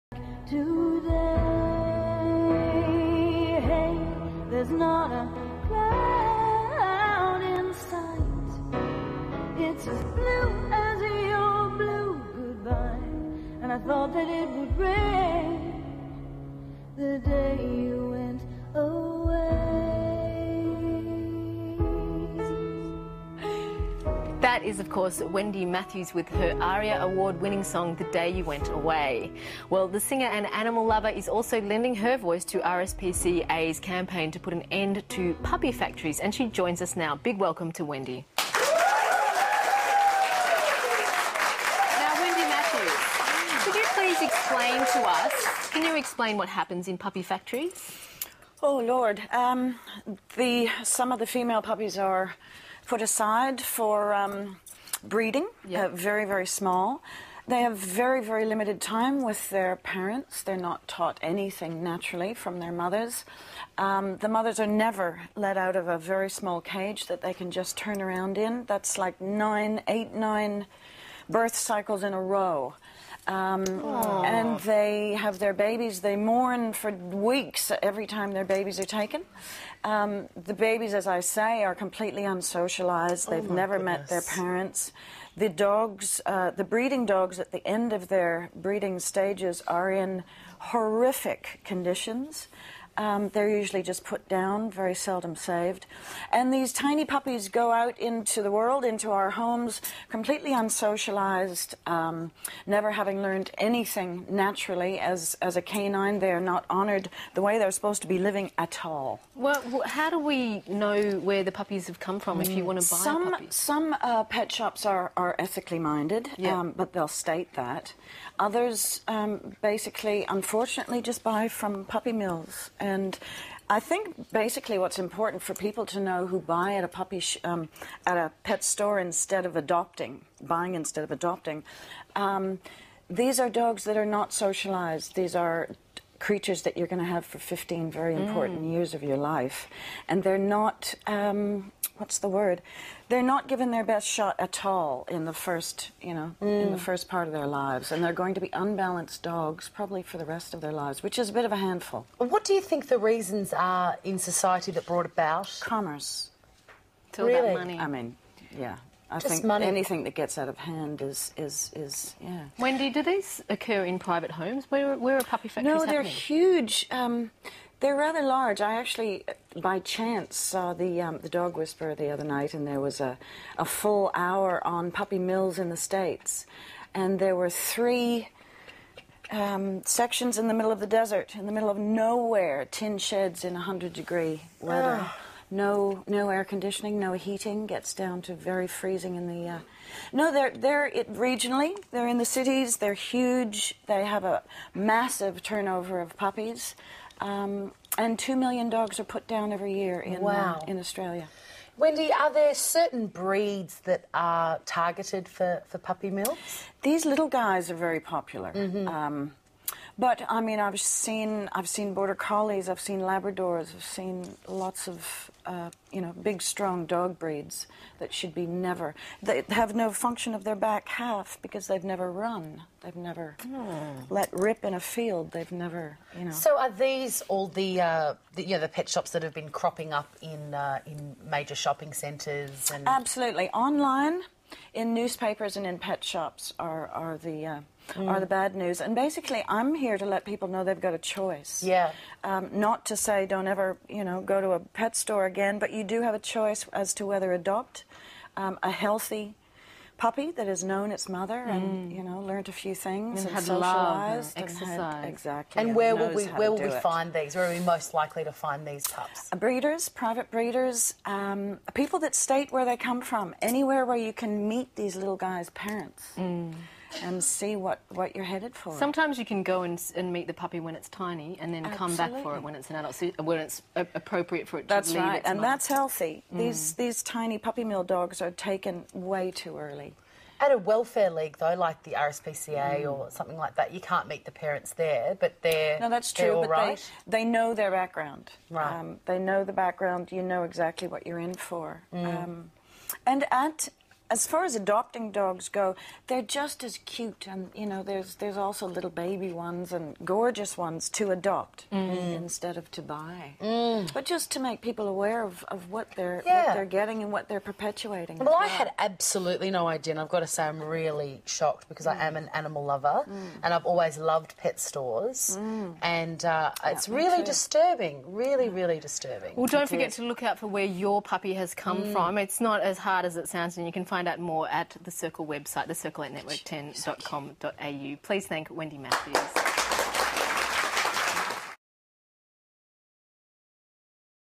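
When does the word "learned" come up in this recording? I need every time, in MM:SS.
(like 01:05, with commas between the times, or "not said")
01:43, 04:12.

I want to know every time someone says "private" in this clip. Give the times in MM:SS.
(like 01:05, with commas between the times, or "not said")
02:43, 04:19.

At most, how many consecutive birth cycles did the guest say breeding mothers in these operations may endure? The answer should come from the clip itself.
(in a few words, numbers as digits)
9.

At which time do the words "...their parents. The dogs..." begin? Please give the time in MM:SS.
01:24.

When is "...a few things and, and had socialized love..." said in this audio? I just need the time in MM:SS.
04:12.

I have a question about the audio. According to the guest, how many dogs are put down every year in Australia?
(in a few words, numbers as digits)
2 million.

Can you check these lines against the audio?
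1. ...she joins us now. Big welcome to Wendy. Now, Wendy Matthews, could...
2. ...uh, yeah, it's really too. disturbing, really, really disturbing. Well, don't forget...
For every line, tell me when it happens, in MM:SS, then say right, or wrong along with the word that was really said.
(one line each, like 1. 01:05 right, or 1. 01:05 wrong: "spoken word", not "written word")
1. 00:36 right
2. 05:16 right.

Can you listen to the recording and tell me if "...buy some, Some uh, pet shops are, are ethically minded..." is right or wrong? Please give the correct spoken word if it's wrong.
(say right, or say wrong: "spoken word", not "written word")
right.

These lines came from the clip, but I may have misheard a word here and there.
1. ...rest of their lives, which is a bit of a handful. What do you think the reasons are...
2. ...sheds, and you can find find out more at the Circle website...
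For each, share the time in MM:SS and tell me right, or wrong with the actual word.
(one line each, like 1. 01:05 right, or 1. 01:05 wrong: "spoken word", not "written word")
1. 02:30 right
2. 05:23 wrong: "sounds", not "sheds".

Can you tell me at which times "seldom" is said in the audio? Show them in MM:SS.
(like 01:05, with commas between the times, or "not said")
01:34.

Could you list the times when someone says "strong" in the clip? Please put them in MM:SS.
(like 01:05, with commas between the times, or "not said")
03:36.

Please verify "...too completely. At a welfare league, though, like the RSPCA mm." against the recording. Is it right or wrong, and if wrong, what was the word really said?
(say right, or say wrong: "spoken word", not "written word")
wrong: "early", not "completely".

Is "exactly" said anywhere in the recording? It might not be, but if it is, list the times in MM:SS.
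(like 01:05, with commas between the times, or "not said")
04:15, 04:50.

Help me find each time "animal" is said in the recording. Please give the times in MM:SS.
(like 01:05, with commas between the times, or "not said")
00:30, 05:12.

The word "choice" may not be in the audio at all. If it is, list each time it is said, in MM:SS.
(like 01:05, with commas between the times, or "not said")
04:00, 04:06.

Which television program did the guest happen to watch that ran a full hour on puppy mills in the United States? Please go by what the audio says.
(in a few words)
the Dog Whisperer.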